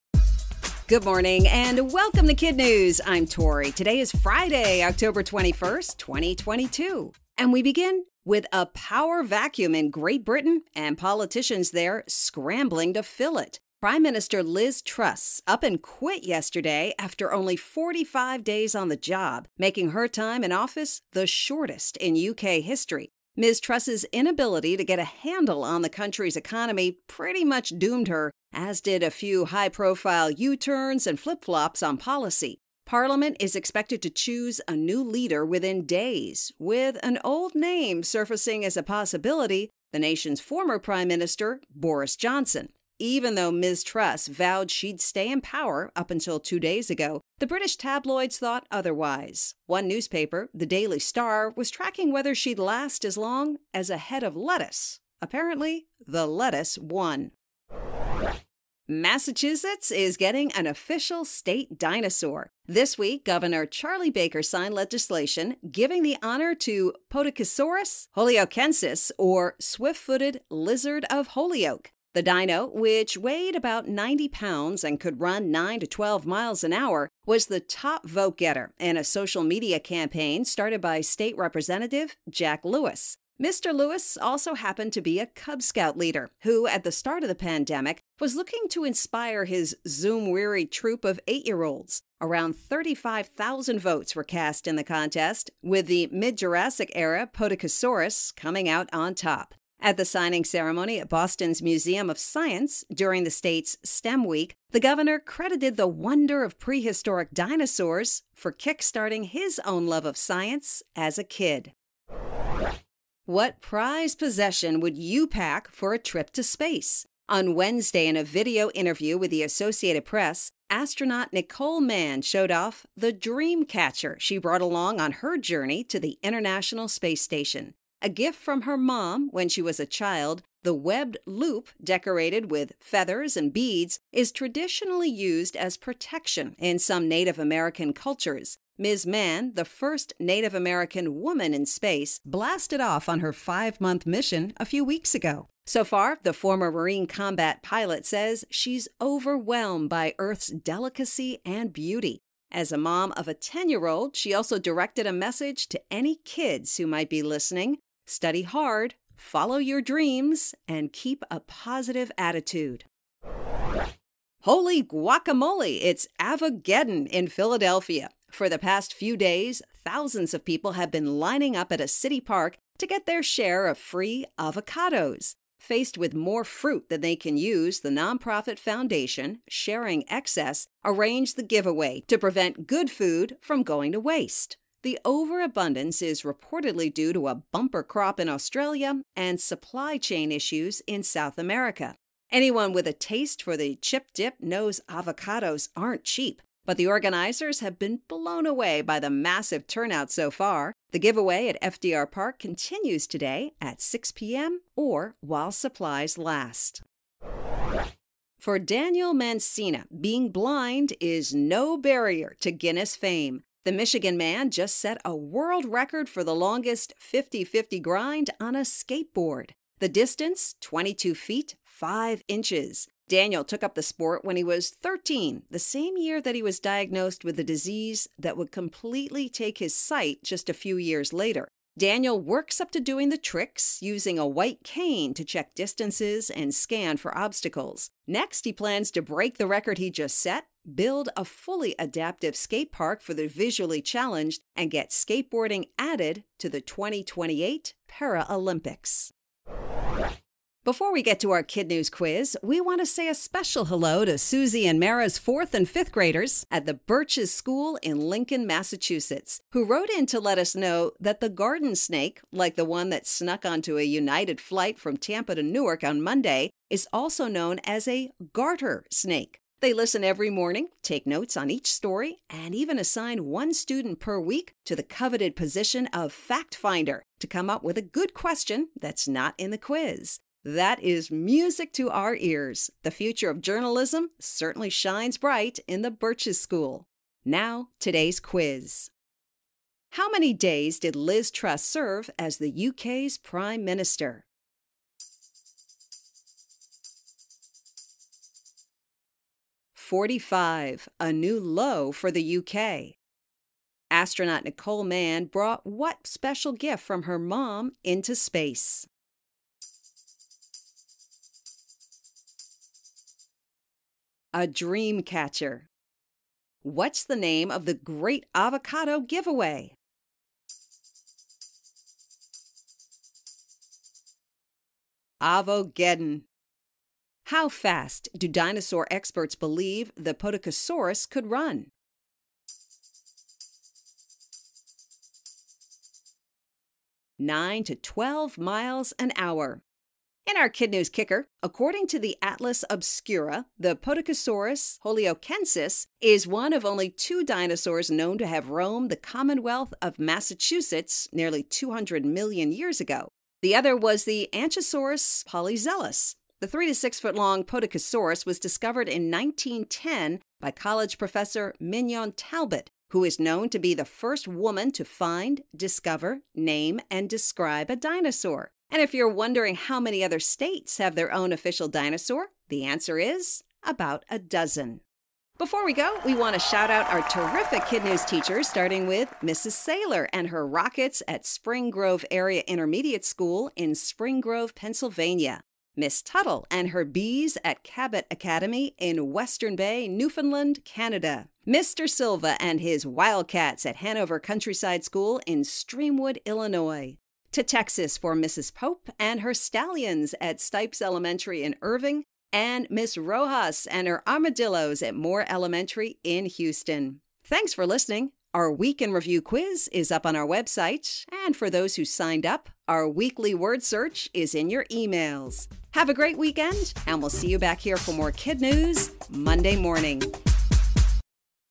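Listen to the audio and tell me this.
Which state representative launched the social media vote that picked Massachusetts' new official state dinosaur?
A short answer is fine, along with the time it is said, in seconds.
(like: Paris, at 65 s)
Jack Lewis, at 82 s.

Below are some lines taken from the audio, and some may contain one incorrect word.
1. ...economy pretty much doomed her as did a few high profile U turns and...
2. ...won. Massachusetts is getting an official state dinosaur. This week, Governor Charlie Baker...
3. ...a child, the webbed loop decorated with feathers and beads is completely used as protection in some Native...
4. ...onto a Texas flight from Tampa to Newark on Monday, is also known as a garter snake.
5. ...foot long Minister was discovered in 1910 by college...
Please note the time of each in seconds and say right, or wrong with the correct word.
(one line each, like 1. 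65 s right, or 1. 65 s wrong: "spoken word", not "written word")
1. 26 s right
2. 56 s right
3. 129 s wrong: "traditionally", not "completely"
4. 263 s wrong: "United", not "Texas"
5. 356 s wrong: "Podokesaurus", not "Minister".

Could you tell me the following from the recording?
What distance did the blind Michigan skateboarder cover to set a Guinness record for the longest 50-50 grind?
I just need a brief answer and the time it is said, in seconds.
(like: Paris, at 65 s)
22 feet, 5 inches, at 220 s.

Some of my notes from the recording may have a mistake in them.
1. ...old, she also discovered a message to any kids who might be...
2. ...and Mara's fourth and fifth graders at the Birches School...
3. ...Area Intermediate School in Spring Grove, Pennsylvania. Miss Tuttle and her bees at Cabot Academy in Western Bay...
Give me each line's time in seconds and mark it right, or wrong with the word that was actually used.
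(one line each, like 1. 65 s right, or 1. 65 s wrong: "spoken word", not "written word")
1. 153 s wrong: "directed", not "discovered"
2. 254 s right
3. 382 s right.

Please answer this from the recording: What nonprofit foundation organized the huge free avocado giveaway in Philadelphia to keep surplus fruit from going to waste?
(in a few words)
Sharing Excess.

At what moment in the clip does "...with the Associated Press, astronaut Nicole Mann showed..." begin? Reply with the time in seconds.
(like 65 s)
119 s.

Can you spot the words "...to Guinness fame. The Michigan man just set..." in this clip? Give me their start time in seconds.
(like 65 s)
212 s.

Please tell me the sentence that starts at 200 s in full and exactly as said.
The giveaway at FDR Park continues today at 6 p.m.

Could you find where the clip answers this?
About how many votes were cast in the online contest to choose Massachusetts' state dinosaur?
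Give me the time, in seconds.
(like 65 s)
92 s.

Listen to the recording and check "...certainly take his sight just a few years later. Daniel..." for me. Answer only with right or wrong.
wrong.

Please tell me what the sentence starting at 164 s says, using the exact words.
Holy guacamole, it's Avogeddon in Philadelphia.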